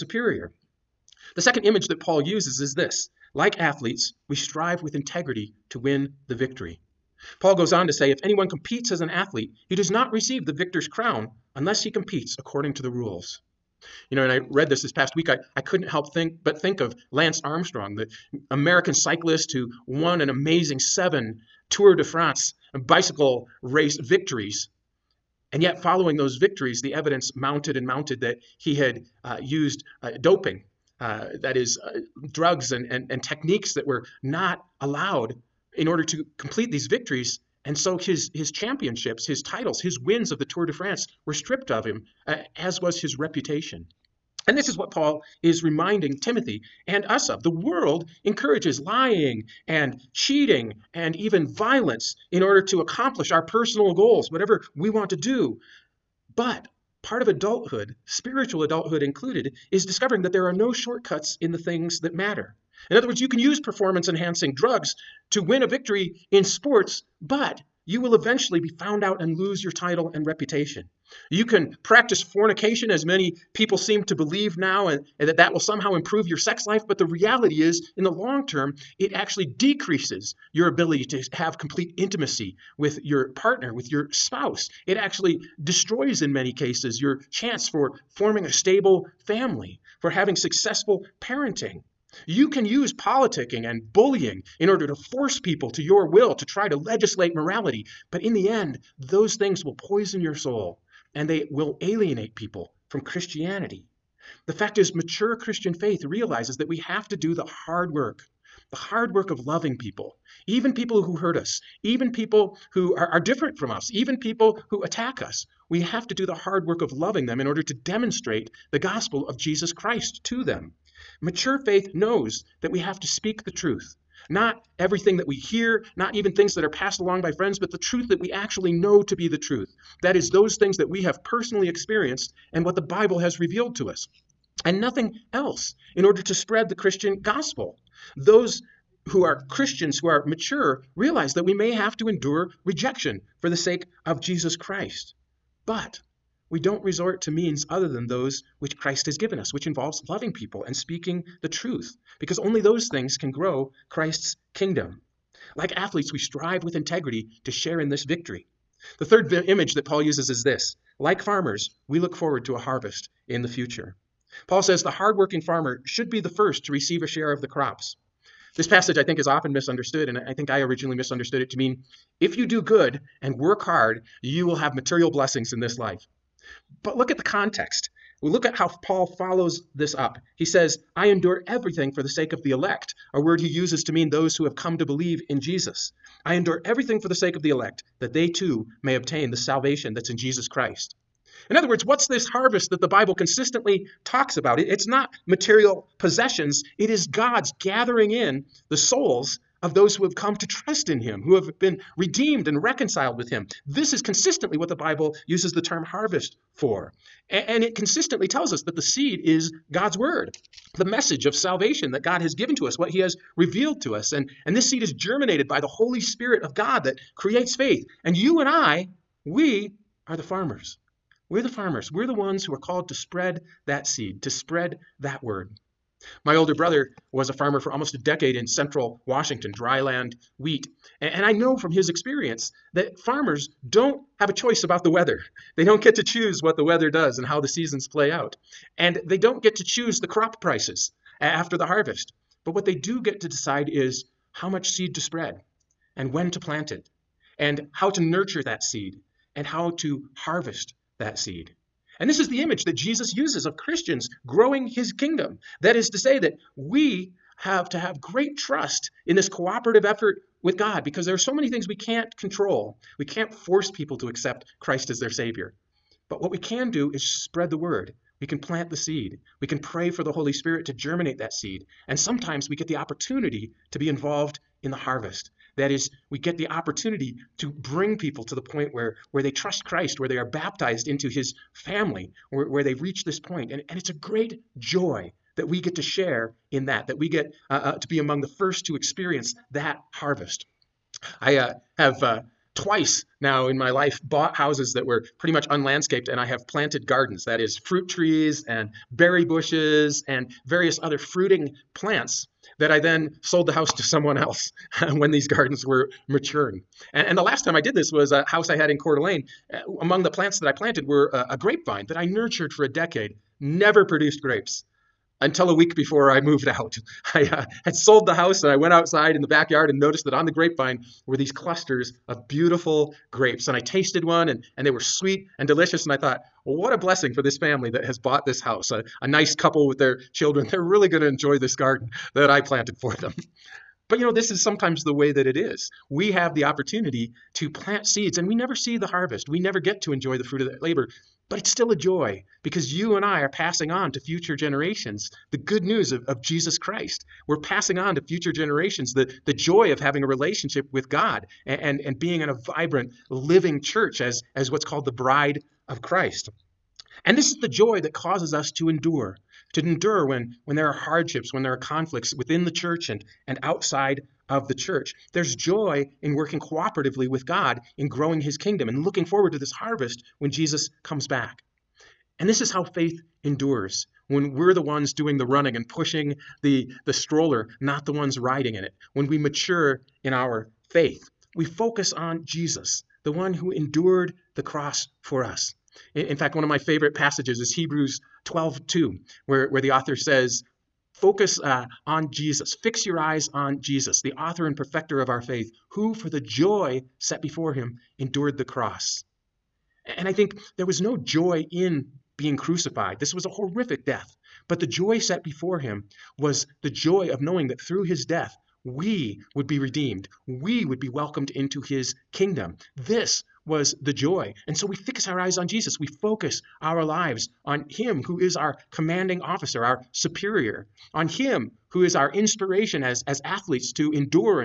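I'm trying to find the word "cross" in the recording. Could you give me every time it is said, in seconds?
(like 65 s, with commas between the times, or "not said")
384 s, 398 s.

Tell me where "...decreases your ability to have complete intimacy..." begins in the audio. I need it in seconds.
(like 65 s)
79 s.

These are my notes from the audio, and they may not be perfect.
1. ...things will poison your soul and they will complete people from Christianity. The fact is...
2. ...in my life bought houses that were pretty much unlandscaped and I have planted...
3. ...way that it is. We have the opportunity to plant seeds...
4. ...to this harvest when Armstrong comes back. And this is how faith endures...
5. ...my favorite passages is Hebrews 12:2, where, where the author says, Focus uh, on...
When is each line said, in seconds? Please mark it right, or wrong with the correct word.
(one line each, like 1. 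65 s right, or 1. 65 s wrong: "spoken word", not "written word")
1. 99 s wrong: "alienate", not "complete"
2. 293 s right
3. 334 s right
4. 369 s wrong: "Jesus", not "Armstrong"
5. 386 s right.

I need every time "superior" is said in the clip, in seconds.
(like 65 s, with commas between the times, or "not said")
419 s.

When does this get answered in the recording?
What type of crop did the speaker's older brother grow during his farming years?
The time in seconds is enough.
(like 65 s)
229 s.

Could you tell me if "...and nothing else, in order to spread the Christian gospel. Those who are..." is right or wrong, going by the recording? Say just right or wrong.
right.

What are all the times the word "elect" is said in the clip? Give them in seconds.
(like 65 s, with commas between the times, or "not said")
182 s, 187 s.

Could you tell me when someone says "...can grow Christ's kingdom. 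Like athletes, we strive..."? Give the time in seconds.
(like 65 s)
153 s.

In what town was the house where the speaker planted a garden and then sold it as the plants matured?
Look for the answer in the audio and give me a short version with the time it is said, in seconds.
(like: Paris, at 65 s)
Coeur d'Alene, at 308 s.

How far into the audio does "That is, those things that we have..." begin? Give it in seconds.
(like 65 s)
130 s.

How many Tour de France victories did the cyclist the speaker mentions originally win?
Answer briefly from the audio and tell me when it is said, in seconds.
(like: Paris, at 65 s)
7, at 20 s.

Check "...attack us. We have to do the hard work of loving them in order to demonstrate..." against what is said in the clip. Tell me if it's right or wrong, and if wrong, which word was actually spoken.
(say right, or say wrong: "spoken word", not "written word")
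right.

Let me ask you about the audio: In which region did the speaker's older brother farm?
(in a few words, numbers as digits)
central Washington.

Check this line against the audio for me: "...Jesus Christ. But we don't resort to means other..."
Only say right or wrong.
right.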